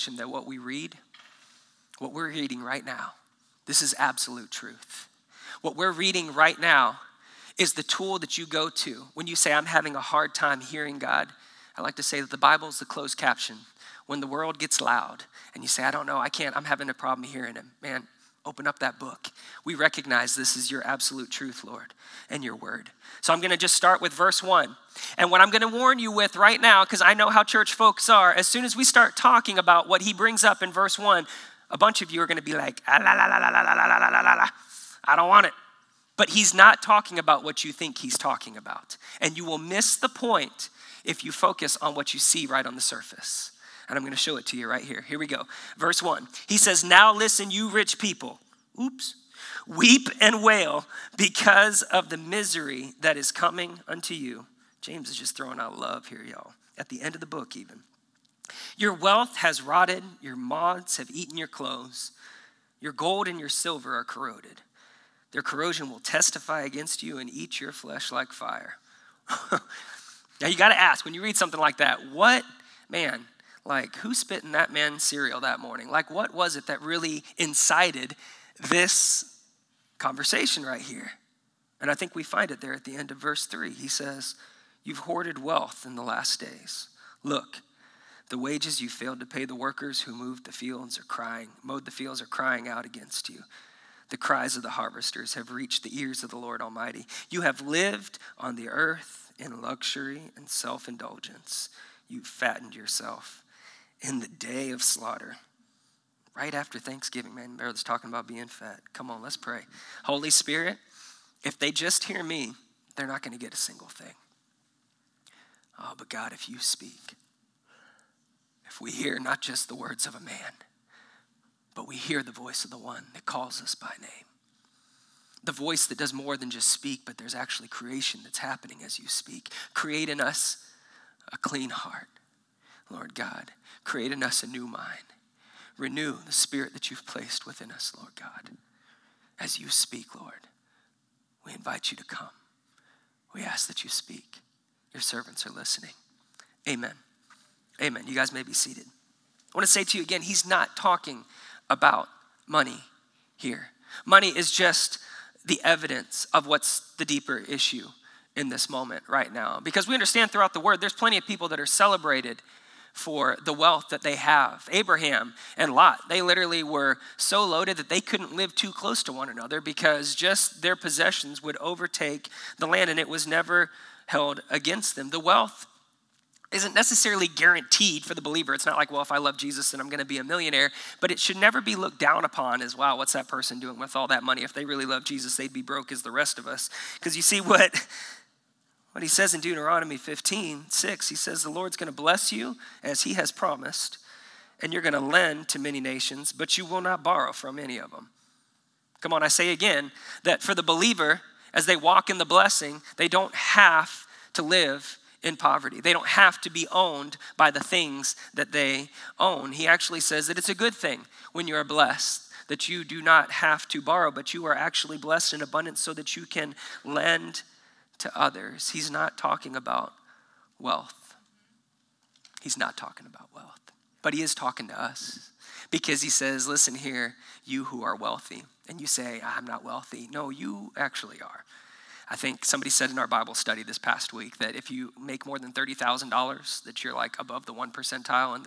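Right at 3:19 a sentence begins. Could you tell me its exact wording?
Come on, I say again that for the believer, as they walk in the blessing, they don't have to live in poverty.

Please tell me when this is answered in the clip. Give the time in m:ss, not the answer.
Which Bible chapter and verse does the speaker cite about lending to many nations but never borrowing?
3:09.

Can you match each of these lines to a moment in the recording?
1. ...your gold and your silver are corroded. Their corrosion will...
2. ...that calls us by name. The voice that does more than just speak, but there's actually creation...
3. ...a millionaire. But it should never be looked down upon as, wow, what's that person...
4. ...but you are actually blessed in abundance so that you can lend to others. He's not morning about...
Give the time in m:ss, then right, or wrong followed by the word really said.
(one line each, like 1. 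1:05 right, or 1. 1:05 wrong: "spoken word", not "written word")
1. 1:02 right
2. 2:03 right
3. 3:00 right
4. 3:34 wrong: "talking", not "morning".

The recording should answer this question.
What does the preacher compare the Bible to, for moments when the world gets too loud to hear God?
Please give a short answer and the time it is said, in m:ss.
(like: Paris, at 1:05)
closed caption, at 0:12.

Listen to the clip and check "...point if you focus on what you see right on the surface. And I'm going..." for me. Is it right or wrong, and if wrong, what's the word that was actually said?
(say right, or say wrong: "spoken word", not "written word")
right.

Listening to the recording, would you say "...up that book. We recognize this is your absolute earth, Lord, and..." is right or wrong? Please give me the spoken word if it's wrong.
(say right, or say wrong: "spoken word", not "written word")
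wrong: "truth", not "earth".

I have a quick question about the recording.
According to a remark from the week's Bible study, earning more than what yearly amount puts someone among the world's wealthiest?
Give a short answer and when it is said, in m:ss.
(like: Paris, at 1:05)
$30,000, at 3:55.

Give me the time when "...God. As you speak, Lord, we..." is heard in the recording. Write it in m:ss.
2:18.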